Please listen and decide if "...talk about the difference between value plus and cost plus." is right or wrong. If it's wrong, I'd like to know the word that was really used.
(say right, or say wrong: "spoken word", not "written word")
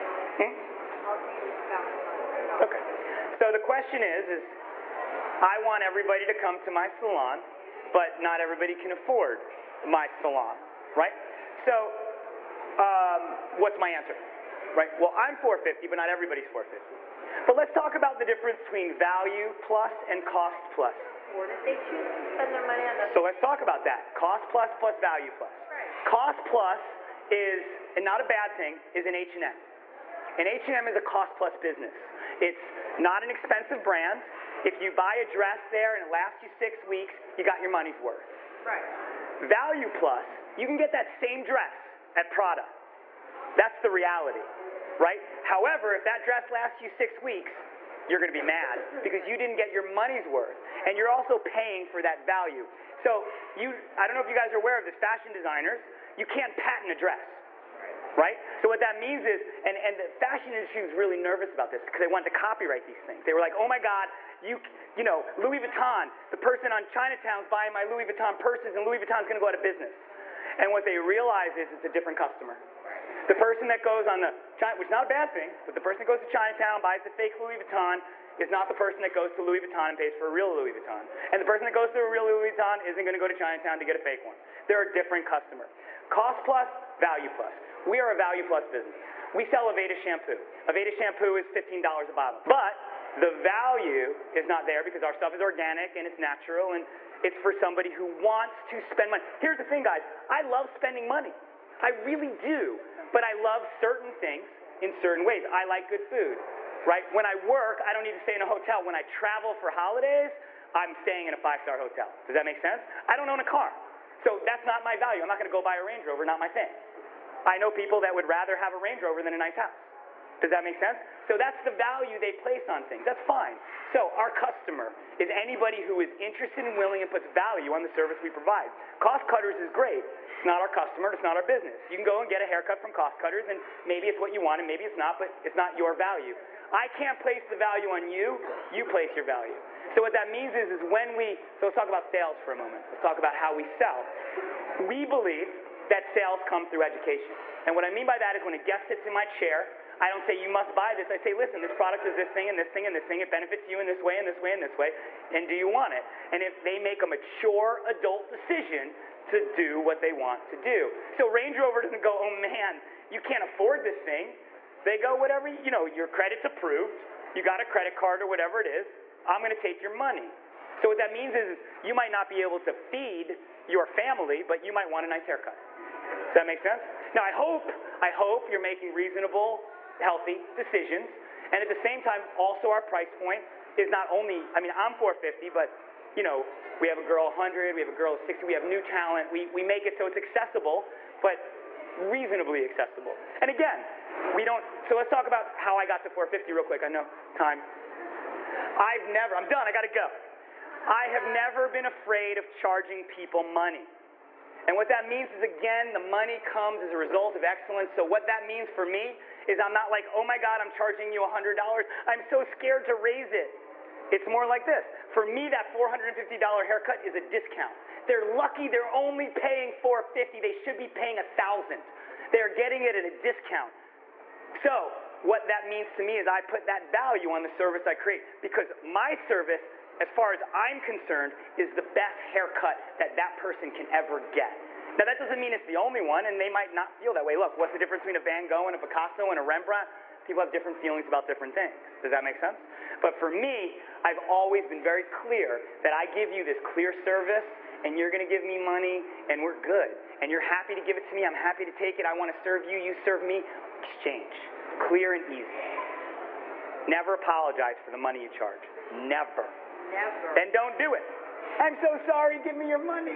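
right.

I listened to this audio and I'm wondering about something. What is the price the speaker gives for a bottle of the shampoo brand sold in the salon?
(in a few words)
$15.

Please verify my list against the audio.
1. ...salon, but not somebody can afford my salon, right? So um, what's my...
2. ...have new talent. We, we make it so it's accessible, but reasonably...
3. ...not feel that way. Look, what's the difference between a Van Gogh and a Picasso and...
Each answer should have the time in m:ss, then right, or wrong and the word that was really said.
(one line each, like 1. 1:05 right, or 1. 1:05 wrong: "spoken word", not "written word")
1. 0:06 wrong: "everybody", not "somebody"
2. 3:08 right
3. 3:56 right.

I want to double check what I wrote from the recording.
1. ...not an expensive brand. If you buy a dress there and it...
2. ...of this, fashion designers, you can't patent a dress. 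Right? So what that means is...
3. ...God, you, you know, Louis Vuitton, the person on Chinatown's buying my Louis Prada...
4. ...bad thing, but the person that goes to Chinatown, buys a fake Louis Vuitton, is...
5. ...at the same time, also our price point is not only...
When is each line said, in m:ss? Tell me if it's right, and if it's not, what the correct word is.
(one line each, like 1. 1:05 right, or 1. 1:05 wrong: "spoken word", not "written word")
1. 0:32 right
2. 0:54 right
3. 1:03 wrong: "Vuitton", not "Prada"
4. 1:15 right
5. 3:01 right.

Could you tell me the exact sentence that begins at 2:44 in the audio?
They go, whatever, you know, your credit's approved.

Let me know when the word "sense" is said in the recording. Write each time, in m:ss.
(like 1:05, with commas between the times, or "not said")
1:52, 2:00, 2:56, 4:02.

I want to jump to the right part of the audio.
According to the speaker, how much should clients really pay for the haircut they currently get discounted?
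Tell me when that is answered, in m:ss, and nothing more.
3:41.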